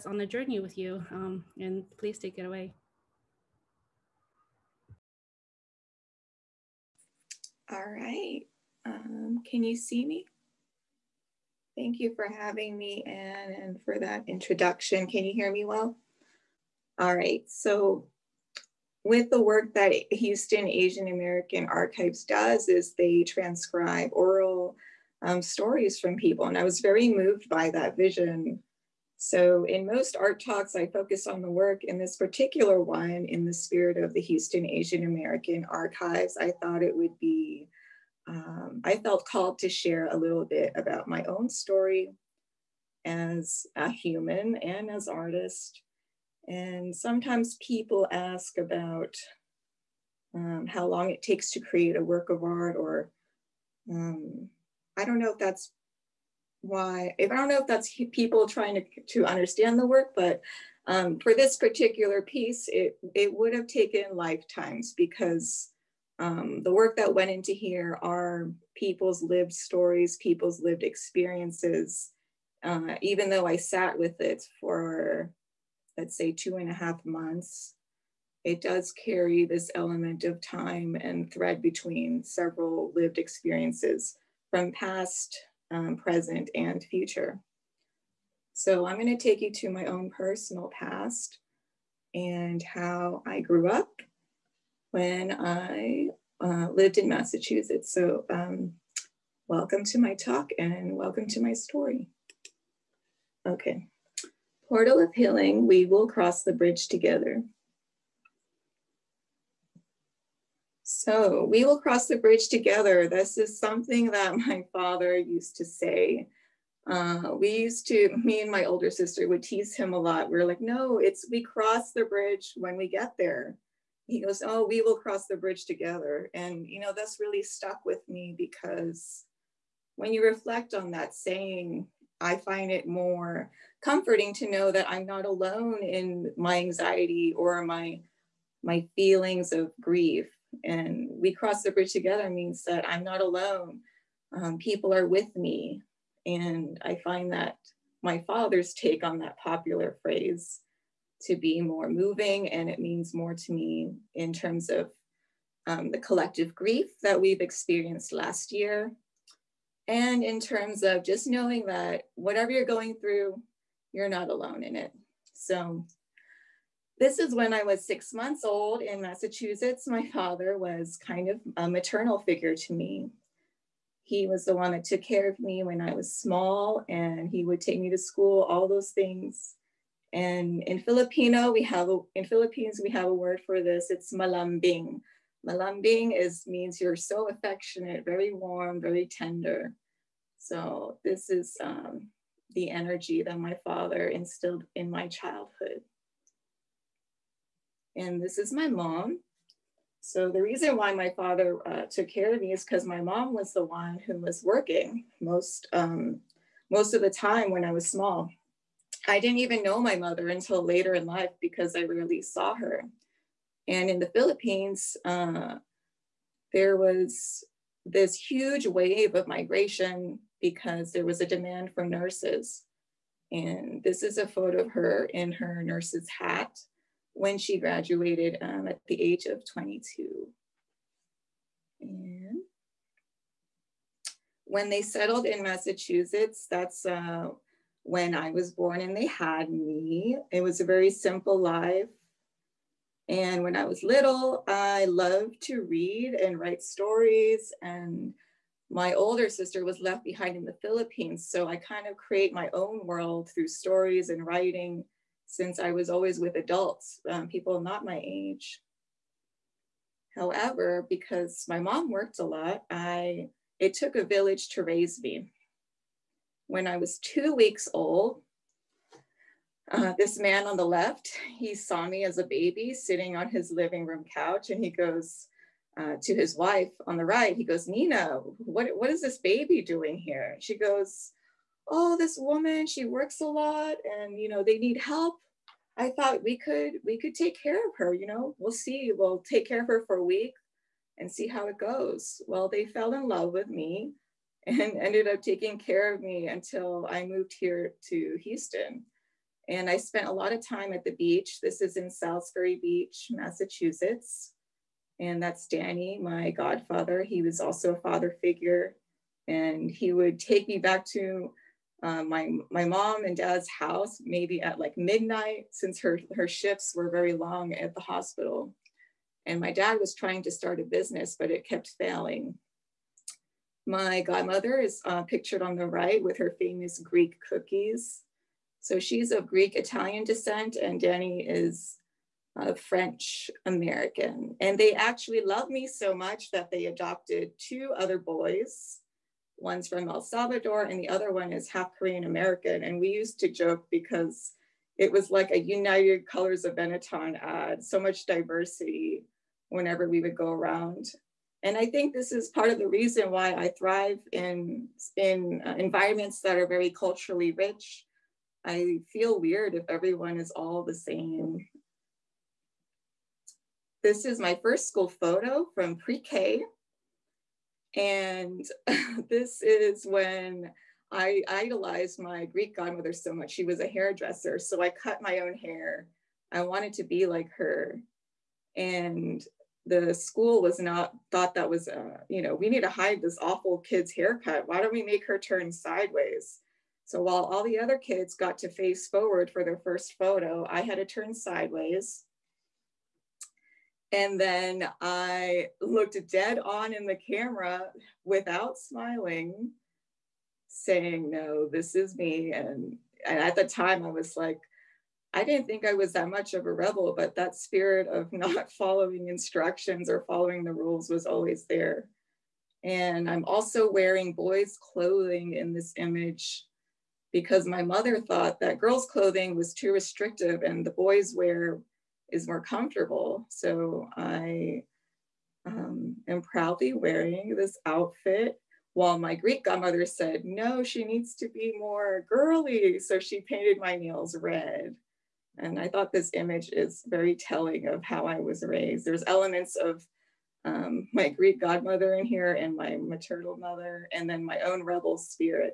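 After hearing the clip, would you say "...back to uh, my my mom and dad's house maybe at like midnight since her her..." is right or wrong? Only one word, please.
right.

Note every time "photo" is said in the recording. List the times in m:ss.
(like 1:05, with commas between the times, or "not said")
3:44, 6:04, 6:29.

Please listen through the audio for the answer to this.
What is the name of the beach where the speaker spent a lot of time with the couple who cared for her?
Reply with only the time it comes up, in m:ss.
5:01.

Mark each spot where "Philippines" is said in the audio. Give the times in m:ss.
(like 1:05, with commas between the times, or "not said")
3:02, 3:34, 4:10.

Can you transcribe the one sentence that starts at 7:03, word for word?
So I um, am proudly wearing this outfit while my Greek godmother said, no, she needs to be more girly.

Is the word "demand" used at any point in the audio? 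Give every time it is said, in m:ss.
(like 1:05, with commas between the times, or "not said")
3:41.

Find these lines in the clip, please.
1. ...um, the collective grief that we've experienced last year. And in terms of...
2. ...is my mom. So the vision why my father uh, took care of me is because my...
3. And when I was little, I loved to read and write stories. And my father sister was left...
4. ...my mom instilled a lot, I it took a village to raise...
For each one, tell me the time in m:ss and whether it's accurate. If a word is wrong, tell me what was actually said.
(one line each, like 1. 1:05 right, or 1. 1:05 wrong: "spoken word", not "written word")
1. 2:35 right
2. 3:18 wrong: "reason", not "vision"
3. 4:03 wrong: "older", not "father"
4. 4:21 wrong: "worked", not "instilled".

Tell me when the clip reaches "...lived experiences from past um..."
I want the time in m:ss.
1:22.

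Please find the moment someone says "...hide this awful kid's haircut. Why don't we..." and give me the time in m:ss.
6:22.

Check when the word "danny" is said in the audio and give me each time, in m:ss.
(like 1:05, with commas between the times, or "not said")
5:05, 5:30.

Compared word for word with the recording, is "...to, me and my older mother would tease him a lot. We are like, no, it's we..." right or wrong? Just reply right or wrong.
wrong.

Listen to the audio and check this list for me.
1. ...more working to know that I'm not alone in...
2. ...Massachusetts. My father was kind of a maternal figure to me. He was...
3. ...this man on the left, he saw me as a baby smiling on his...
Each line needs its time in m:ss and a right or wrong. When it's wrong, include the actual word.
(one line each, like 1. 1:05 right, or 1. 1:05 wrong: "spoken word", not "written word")
1. 2:12 wrong: "comforting", not "working"
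2. 2:48 right
3. 4:29 wrong: "sitting", not "smiling".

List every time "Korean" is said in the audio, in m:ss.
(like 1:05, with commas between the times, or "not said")
5:41.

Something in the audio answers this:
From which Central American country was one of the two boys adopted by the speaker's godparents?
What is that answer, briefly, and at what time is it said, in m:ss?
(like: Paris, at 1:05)
El Salvador, at 5:39.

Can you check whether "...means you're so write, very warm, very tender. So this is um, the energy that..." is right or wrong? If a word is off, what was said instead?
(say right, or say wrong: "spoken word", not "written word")
wrong: "affectionate", not "write".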